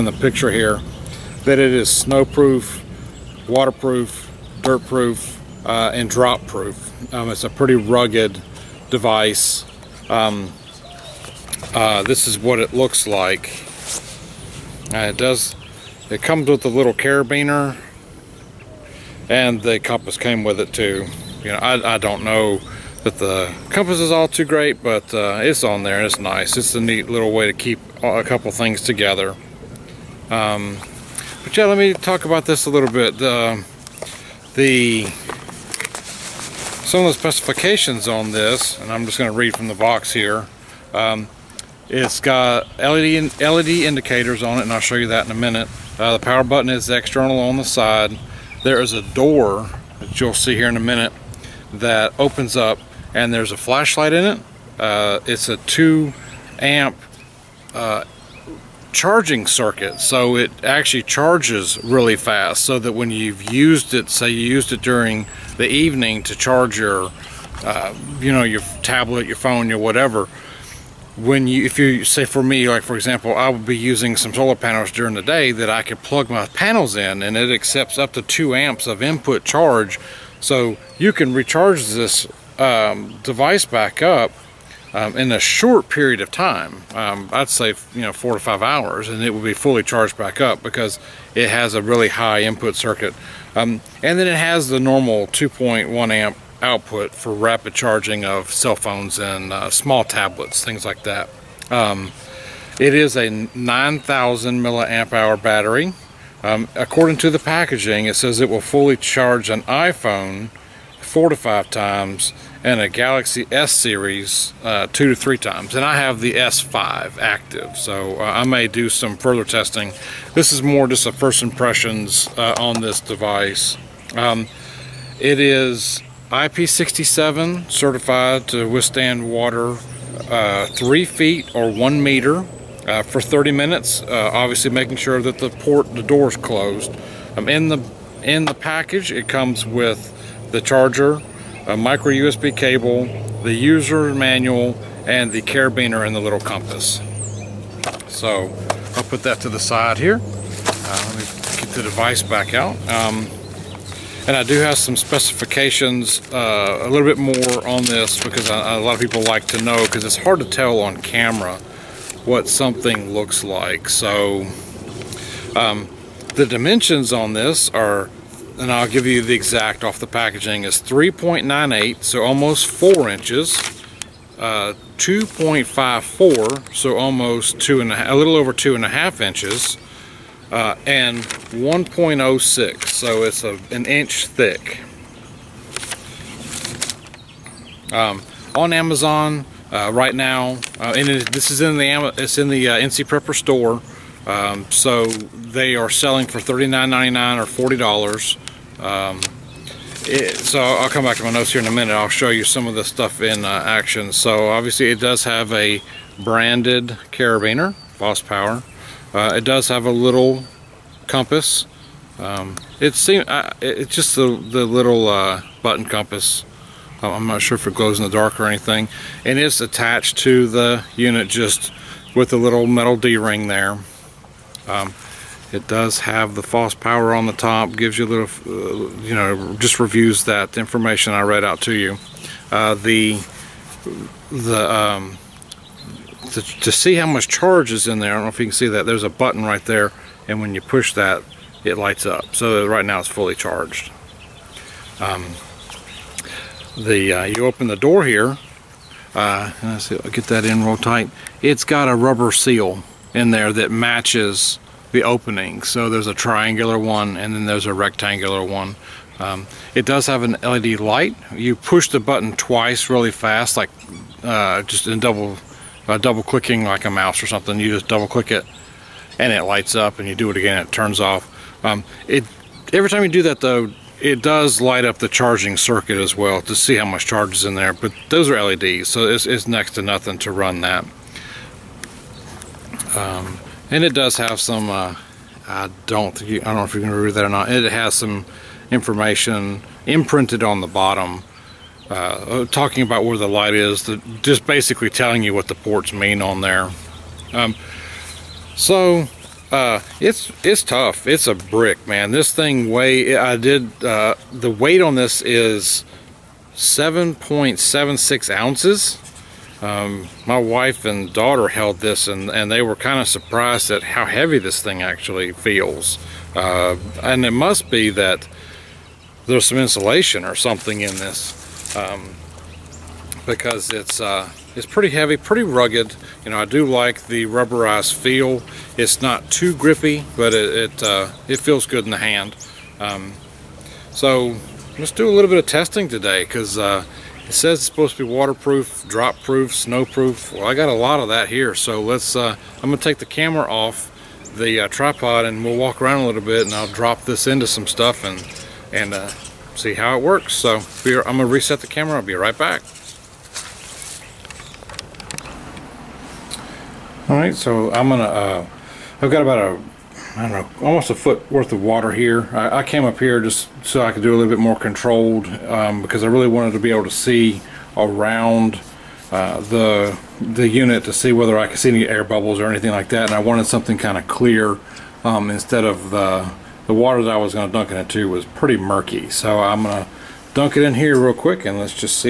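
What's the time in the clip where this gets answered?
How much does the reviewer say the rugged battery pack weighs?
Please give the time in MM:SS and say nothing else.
05:06.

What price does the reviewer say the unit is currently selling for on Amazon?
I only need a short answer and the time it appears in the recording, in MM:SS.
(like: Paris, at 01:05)
$39.99, at 03:16.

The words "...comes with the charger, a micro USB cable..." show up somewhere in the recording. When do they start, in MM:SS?
02:19.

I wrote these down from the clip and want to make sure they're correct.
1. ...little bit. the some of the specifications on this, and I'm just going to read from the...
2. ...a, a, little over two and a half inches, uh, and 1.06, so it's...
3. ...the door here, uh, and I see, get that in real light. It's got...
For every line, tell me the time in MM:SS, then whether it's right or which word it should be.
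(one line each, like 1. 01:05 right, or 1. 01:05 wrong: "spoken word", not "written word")
1. 00:32 right
2. 02:57 right
3. 04:07 wrong: "tight", not "light".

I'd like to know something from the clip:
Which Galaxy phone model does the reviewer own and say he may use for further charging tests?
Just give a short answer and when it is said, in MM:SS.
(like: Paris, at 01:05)
S5 active, at 01:56.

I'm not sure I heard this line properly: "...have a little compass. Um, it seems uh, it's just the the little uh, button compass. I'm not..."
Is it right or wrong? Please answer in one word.
right.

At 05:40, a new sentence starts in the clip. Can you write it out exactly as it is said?
Well, I got a lot of that here.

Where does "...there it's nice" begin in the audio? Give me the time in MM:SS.
00:25.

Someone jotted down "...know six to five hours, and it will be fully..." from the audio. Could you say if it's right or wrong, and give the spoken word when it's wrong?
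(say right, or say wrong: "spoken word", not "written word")
wrong: "four", not "six".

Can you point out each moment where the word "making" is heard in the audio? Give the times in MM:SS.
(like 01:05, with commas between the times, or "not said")
02:14.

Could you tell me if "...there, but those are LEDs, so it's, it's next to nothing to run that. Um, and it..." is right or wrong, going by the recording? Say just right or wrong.
right.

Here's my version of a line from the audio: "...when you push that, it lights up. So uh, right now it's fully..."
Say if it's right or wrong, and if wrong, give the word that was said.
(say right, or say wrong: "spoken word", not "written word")
right.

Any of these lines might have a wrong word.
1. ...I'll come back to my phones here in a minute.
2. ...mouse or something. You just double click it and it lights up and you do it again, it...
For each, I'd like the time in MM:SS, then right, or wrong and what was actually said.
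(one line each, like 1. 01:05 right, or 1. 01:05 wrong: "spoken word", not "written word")
1. 03:20 wrong: "notes", not "phones"
2. 04:26 right.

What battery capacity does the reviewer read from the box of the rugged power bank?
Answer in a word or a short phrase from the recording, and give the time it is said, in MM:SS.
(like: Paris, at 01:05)
9,000 mAh, at 01:43.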